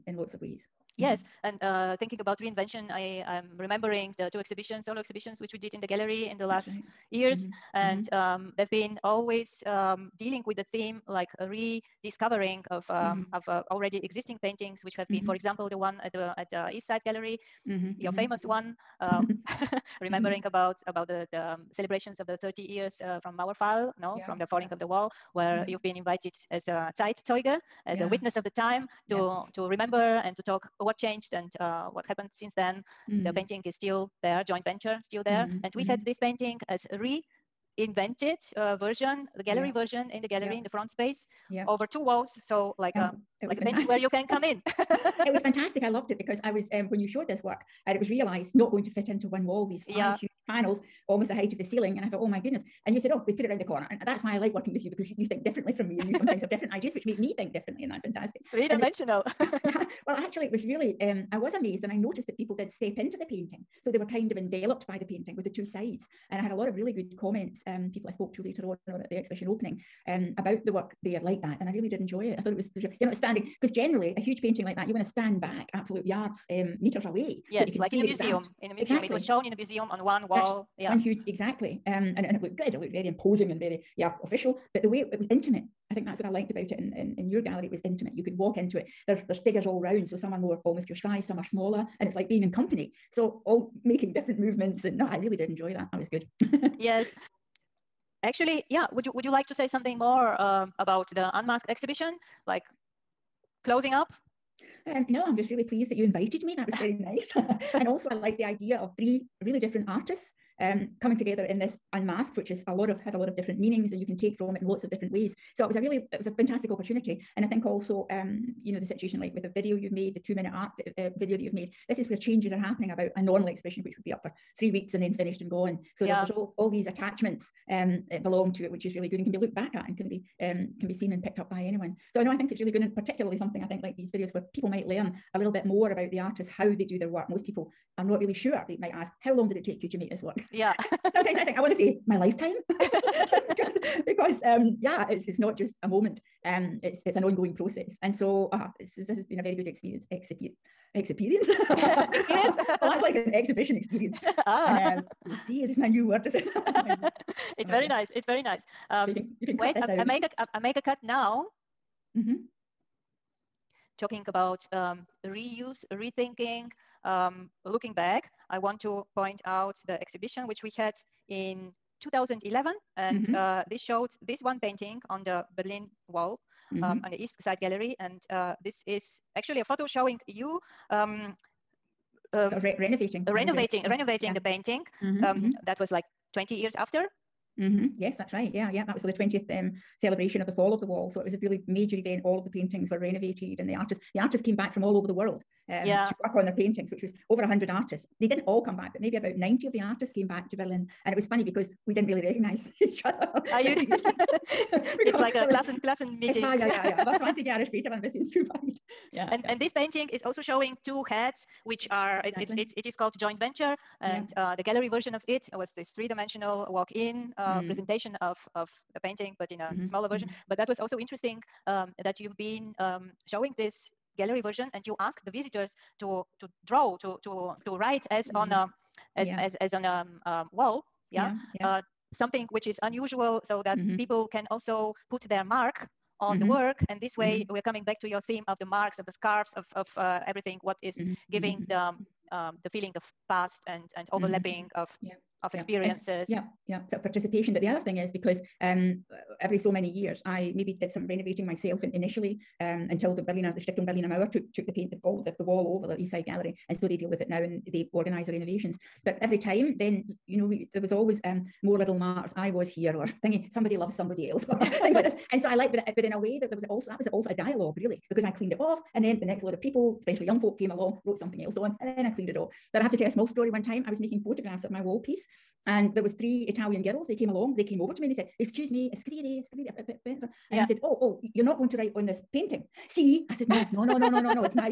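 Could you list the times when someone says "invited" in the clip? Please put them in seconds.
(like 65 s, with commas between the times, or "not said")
25 s, 106 s.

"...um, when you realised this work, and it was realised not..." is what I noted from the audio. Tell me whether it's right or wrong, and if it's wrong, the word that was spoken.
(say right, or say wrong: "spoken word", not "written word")
wrong: "showed", not "realised".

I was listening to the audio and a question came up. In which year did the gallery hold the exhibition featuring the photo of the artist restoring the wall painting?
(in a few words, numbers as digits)
2011.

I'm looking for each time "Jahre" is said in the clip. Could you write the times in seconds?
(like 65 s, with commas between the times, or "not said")
207 s.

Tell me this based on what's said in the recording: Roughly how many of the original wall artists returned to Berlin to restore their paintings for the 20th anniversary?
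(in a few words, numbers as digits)
about 90.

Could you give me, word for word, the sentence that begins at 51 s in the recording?
And I thought, oh my goodness.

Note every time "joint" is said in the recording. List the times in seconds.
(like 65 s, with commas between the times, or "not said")
34 s, 213 s.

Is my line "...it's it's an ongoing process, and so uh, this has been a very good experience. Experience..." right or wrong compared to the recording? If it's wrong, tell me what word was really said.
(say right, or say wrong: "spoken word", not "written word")
right.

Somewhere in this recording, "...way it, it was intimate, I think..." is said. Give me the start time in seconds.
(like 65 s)
84 s.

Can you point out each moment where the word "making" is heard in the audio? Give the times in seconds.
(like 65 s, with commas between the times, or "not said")
93 s, 273 s.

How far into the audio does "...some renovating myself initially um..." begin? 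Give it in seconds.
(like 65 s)
250 s.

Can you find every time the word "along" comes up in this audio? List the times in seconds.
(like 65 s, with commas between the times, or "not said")
270 s, 277 s.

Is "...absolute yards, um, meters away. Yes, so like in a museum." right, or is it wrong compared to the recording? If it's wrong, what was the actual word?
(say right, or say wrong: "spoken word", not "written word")
right.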